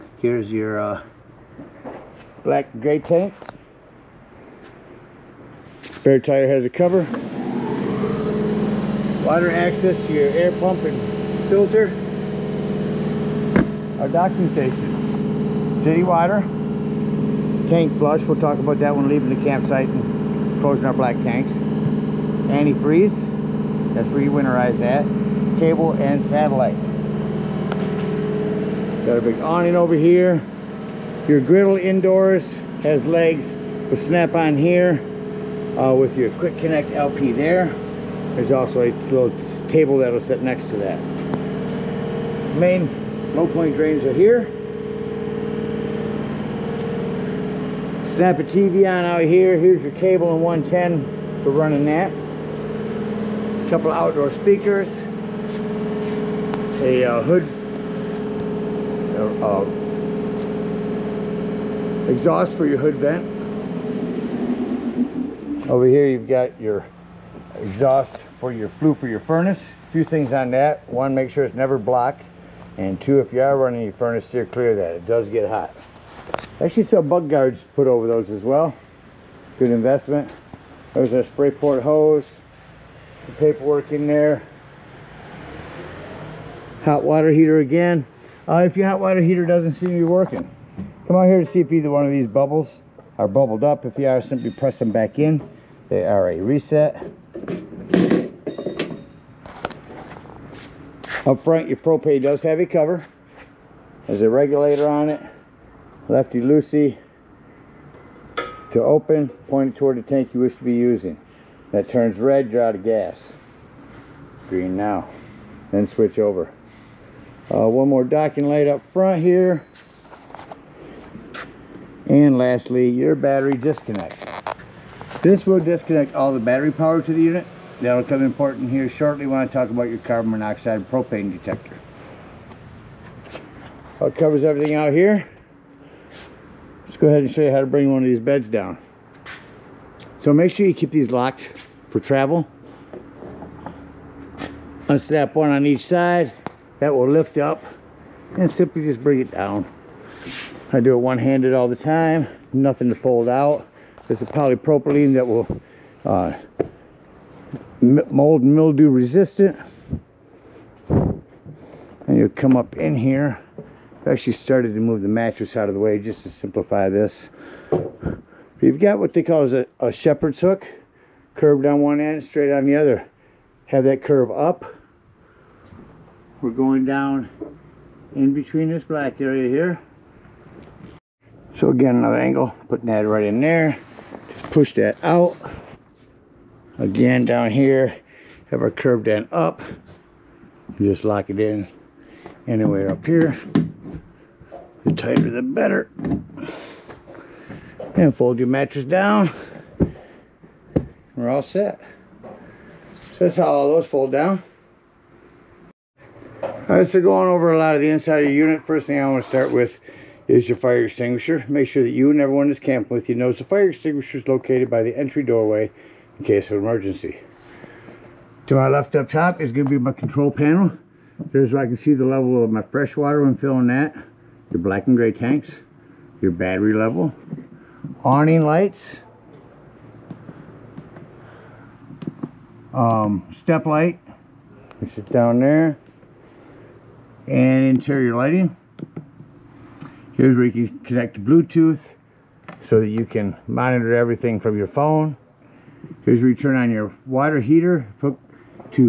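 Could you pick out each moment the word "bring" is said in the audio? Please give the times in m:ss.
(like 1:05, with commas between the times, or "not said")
2:17, 2:29.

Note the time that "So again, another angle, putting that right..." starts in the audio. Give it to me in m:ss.
3:01.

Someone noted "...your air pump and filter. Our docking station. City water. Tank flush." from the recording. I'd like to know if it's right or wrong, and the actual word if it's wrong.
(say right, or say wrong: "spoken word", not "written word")
right.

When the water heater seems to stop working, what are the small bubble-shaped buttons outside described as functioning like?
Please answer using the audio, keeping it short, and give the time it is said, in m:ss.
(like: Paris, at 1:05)
A reset, at 1:35.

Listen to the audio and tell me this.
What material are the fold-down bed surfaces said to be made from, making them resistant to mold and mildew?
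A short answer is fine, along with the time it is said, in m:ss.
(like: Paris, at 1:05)
Polypropylene, at 2:34.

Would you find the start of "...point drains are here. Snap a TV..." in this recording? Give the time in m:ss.
0:43.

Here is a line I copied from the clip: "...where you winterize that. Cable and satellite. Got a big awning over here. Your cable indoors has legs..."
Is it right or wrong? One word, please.
wrong.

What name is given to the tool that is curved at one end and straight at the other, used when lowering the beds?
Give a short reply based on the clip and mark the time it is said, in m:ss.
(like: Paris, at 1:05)
Shepherd's hook, at 2:49.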